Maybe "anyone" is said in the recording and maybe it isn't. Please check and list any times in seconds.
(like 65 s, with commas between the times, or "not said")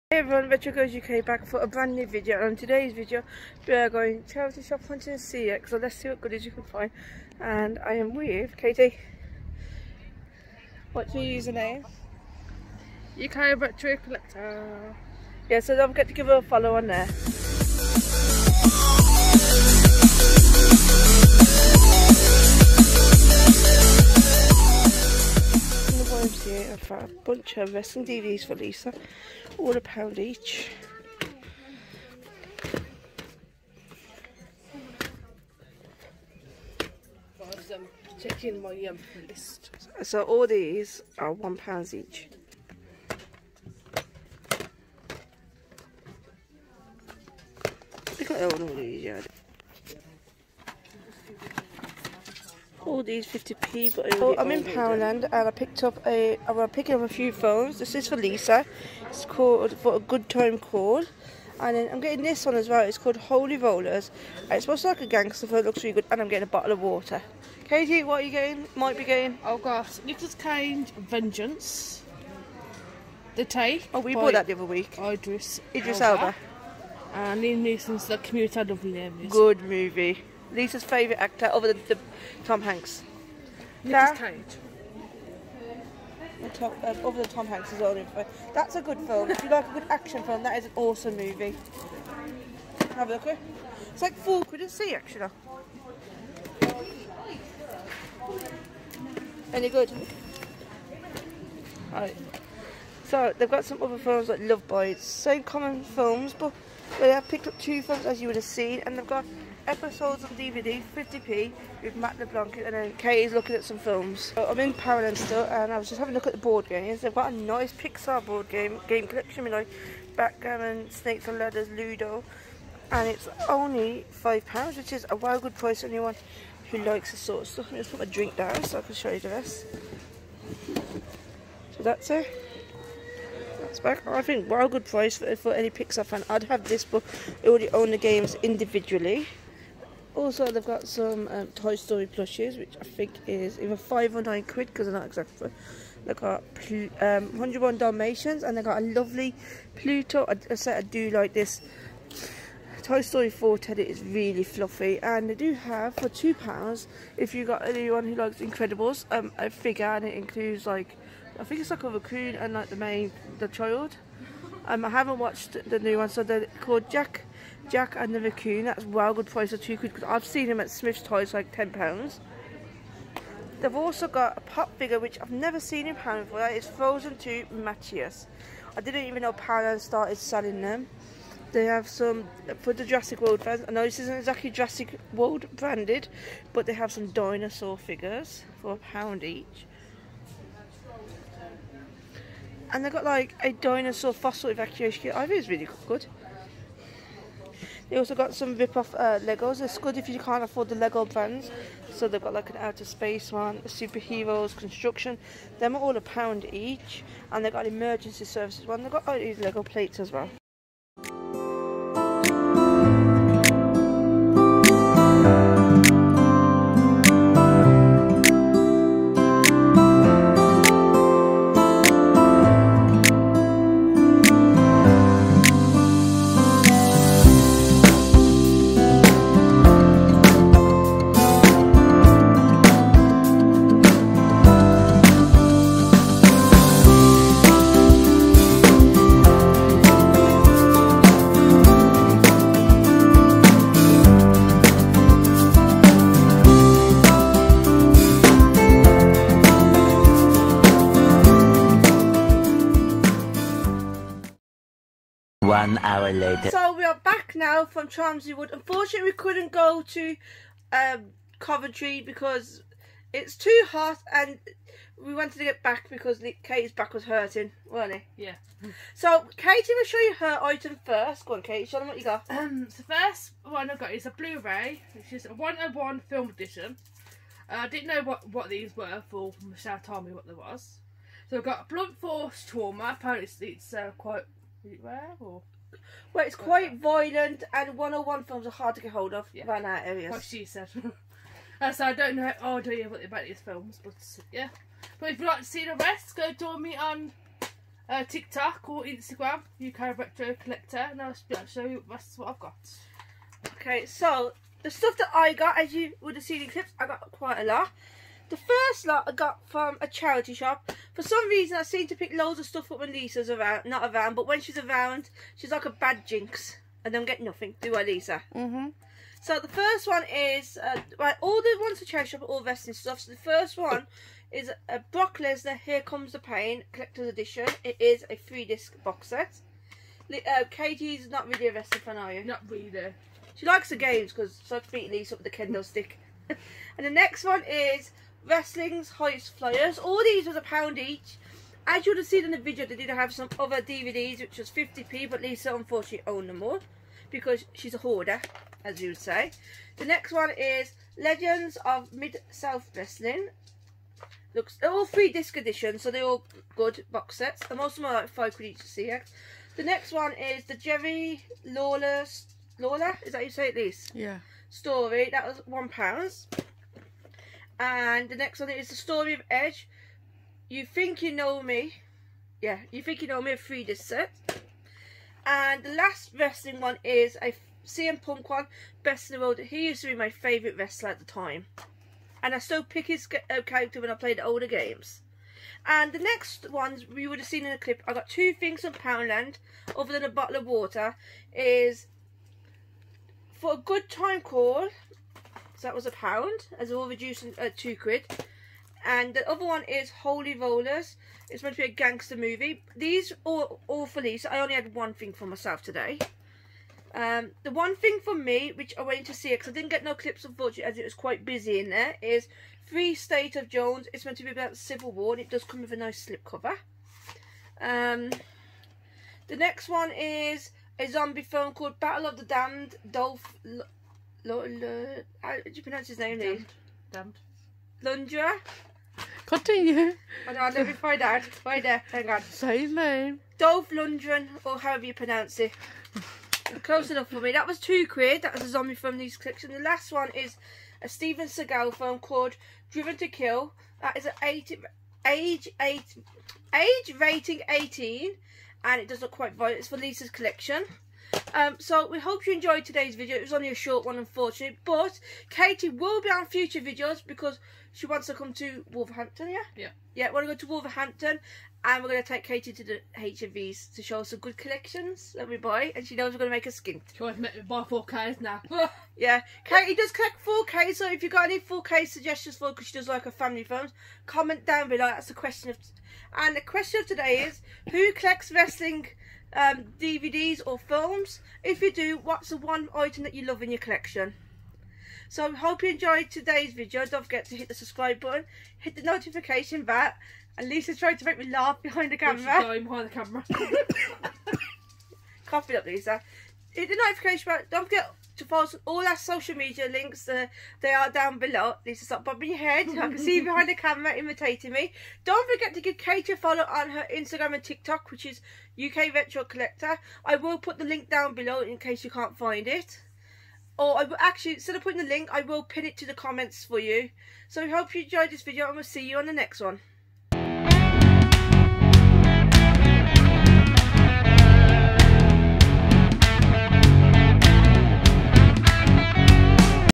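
125 s, 157 s.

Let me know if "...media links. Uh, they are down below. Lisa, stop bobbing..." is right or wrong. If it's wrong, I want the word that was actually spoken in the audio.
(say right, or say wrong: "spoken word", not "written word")
right.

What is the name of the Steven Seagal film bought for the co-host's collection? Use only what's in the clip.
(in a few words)
Driven to Kill.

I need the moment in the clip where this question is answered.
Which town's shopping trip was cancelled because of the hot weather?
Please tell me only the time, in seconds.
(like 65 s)
261 s.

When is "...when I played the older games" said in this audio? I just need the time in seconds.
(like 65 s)
383 s.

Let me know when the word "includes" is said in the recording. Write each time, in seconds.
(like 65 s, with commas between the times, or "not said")
160 s.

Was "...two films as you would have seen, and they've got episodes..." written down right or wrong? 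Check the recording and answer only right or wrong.
right.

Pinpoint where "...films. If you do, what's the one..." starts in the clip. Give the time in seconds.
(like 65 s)
480 s.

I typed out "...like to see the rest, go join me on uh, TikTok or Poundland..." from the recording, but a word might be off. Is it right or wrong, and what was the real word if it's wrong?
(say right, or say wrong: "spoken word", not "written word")
wrong: "Instagram", not "Poundland".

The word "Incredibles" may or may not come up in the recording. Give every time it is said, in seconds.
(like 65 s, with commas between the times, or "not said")
158 s.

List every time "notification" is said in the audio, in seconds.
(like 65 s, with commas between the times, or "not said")
488 s, 496 s.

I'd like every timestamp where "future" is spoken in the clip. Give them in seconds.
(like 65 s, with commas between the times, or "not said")
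456 s.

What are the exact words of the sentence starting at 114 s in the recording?
So I'm in Poundland still, and I was just having a look at the board games.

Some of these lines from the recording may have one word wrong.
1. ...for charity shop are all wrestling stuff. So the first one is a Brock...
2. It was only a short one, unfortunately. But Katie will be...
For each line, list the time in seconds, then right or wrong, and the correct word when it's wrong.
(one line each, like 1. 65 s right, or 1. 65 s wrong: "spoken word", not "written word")
1. 321 s right
2. 453 s right.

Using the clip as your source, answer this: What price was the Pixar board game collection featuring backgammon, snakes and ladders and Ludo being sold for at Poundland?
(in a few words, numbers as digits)
£5.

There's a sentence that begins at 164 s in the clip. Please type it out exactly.
Um, I haven't watched the new one, so they're called Jack Jack and the Raccoon.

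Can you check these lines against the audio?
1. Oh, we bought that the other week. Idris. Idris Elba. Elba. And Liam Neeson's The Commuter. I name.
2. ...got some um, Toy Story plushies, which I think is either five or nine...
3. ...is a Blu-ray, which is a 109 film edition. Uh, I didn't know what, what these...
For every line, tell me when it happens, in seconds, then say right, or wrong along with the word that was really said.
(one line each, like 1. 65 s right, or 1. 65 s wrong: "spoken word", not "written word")
1. 73 s right
2. 140 s right
3. 273 s wrong: "101", not "109".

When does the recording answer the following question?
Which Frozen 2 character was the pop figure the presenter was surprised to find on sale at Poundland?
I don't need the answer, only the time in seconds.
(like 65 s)
177 s.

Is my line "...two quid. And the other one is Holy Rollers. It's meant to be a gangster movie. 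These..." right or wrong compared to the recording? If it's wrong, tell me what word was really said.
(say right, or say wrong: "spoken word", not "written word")
right.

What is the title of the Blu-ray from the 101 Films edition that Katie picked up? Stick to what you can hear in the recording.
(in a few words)
Blunt Force Trauma.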